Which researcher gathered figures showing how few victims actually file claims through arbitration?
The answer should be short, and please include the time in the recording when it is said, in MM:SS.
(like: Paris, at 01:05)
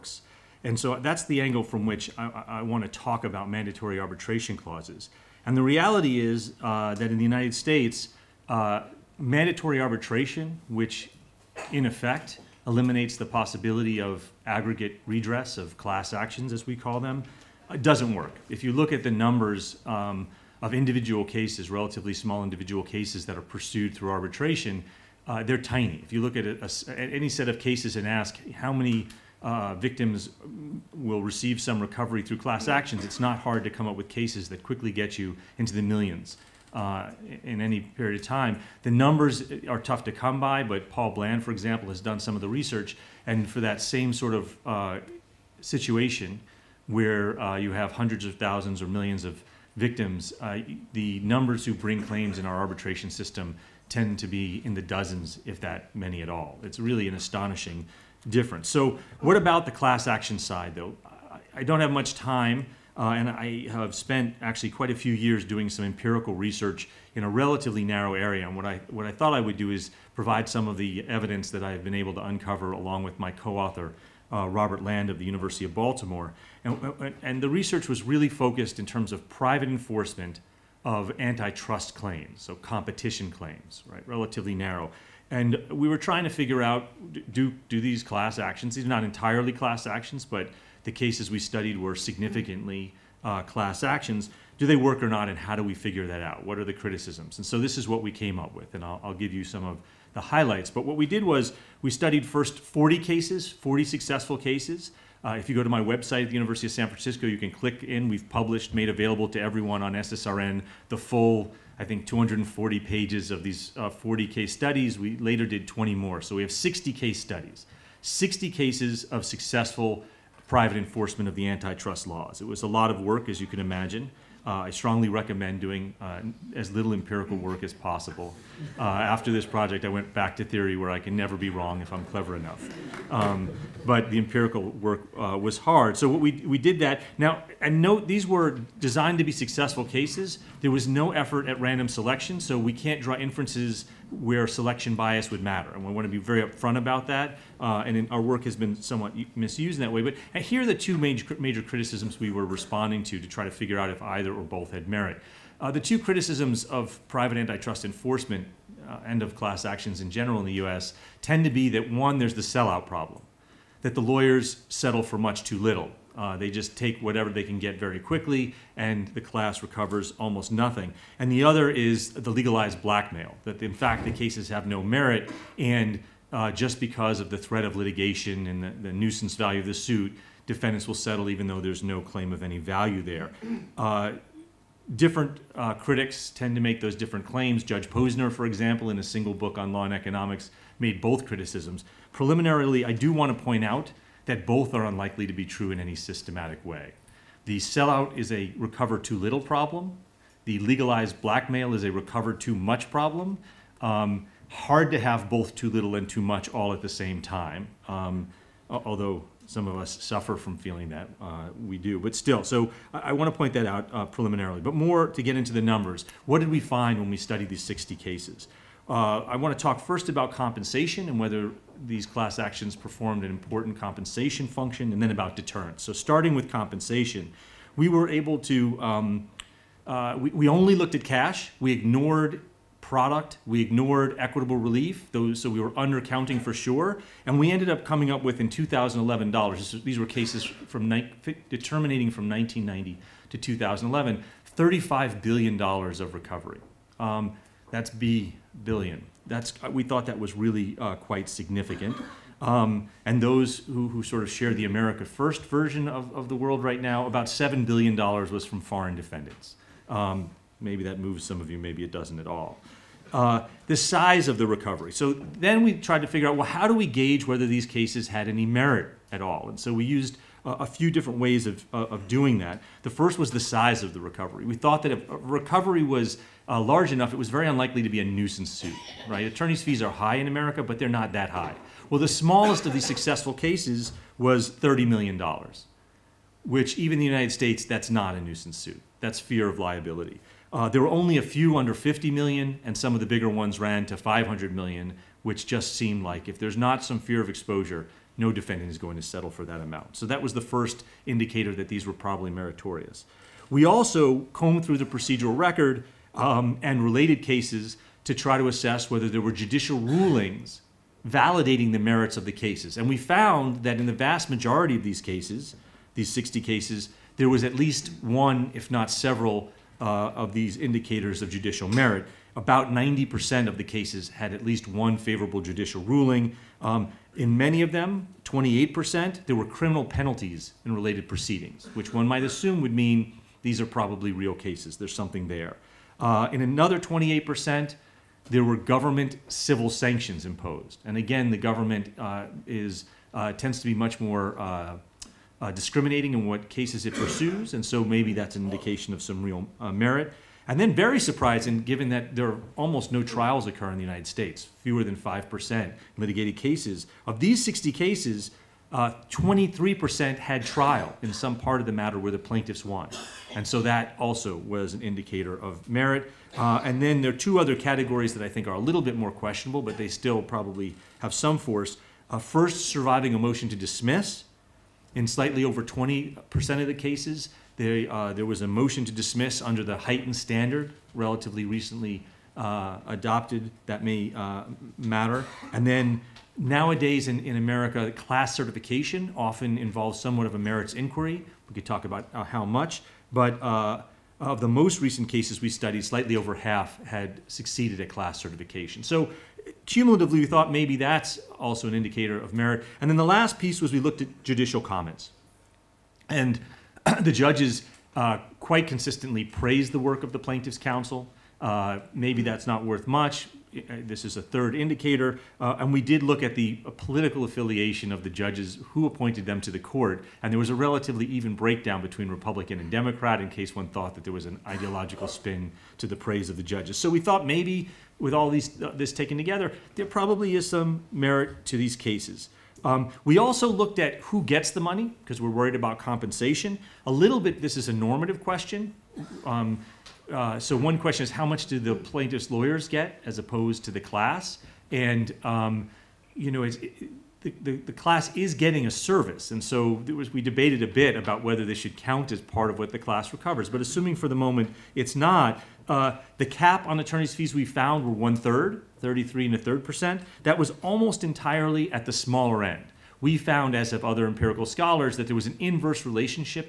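Paul Bland, at 00:40.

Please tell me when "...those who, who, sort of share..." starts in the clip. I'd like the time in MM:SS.
04:13.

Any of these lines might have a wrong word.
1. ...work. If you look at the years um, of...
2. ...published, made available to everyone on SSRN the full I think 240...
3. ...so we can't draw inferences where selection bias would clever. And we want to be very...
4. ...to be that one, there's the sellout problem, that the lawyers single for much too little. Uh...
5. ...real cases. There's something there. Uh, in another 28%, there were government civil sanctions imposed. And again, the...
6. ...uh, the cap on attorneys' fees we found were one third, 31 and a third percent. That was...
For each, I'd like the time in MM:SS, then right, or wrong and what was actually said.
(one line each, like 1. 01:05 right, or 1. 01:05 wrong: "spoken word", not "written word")
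1. 00:18 wrong: "numbers", not "years"
2. 01:48 right
3. 02:22 wrong: "matter", not "clever"
4. 02:41 wrong: "settle", not "single"
5. 05:34 right
6. 07:35 wrong: "33", not "31".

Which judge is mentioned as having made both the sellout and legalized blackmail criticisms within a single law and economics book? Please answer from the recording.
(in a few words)
Judge Posner.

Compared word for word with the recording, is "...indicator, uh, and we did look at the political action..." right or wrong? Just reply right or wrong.
wrong.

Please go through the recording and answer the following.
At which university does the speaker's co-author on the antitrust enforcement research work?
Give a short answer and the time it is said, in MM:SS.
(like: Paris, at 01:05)
University of Baltimore, at 01:15.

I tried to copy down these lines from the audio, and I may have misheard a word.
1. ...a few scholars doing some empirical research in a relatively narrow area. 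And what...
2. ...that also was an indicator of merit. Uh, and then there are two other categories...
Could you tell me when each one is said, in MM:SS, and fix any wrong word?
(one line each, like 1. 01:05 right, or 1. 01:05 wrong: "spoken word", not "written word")
1. 01:04 wrong: "years", not "scholars"
2. 06:03 right.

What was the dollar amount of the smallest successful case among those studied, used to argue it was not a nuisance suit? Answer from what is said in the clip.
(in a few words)
$30 million.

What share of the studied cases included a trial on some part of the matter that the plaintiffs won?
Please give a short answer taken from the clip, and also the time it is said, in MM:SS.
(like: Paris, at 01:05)
23%, at 05:59.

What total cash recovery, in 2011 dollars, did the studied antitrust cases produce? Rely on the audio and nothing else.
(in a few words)
$35 billion.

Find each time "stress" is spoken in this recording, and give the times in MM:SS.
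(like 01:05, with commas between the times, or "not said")
not said.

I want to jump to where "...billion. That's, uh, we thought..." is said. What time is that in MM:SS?
04:08.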